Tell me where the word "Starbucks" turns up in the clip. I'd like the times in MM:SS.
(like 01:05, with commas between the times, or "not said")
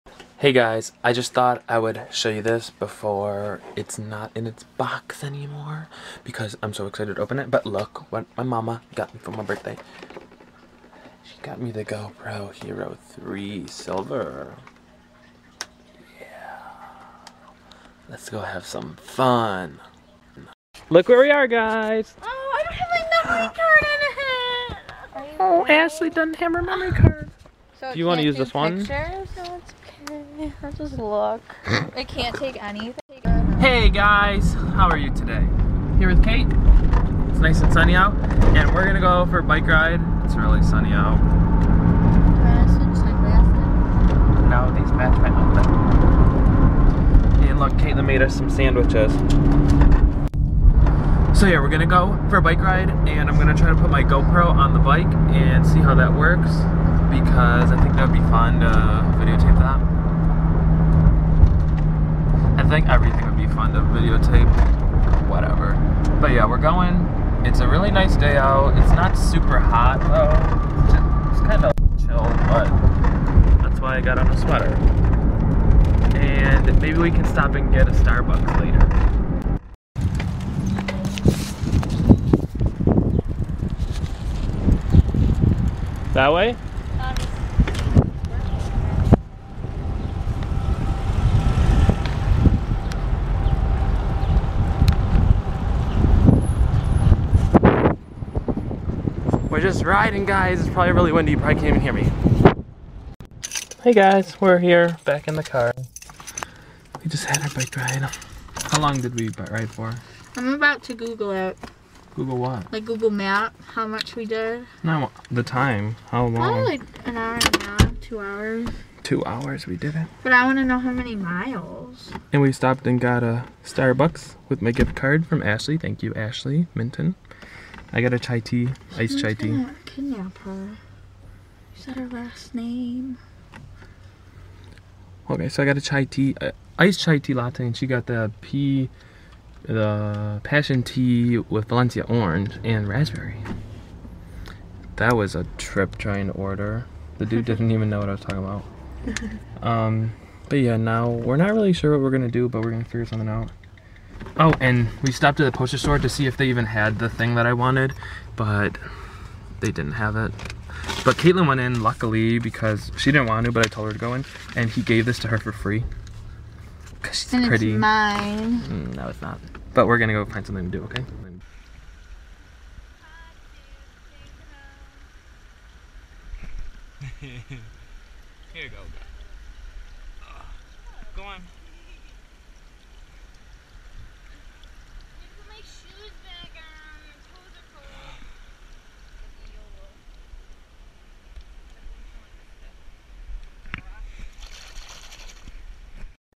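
01:17, 02:03.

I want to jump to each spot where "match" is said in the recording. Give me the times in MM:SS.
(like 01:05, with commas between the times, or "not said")
00:44.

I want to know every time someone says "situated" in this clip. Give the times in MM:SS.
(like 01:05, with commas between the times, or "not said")
not said.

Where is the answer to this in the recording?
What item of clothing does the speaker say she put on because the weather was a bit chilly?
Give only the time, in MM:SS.
01:14.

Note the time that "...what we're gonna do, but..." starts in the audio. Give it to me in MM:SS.
02:31.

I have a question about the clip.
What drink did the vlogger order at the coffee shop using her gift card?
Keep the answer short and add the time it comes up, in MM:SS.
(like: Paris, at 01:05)
iced chai tea latte, at 02:16.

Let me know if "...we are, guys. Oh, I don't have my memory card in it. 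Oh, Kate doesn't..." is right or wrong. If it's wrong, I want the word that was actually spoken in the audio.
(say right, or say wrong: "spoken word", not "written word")
wrong: "Ashley", not "Kate".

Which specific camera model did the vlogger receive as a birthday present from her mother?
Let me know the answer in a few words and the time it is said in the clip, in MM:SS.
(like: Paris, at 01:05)
GoPro Hero 3 Silver, at 00:11.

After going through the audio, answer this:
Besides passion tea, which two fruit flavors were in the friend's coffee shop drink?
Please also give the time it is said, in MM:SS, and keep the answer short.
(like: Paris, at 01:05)
Valencia orange and raspberry, at 02:21.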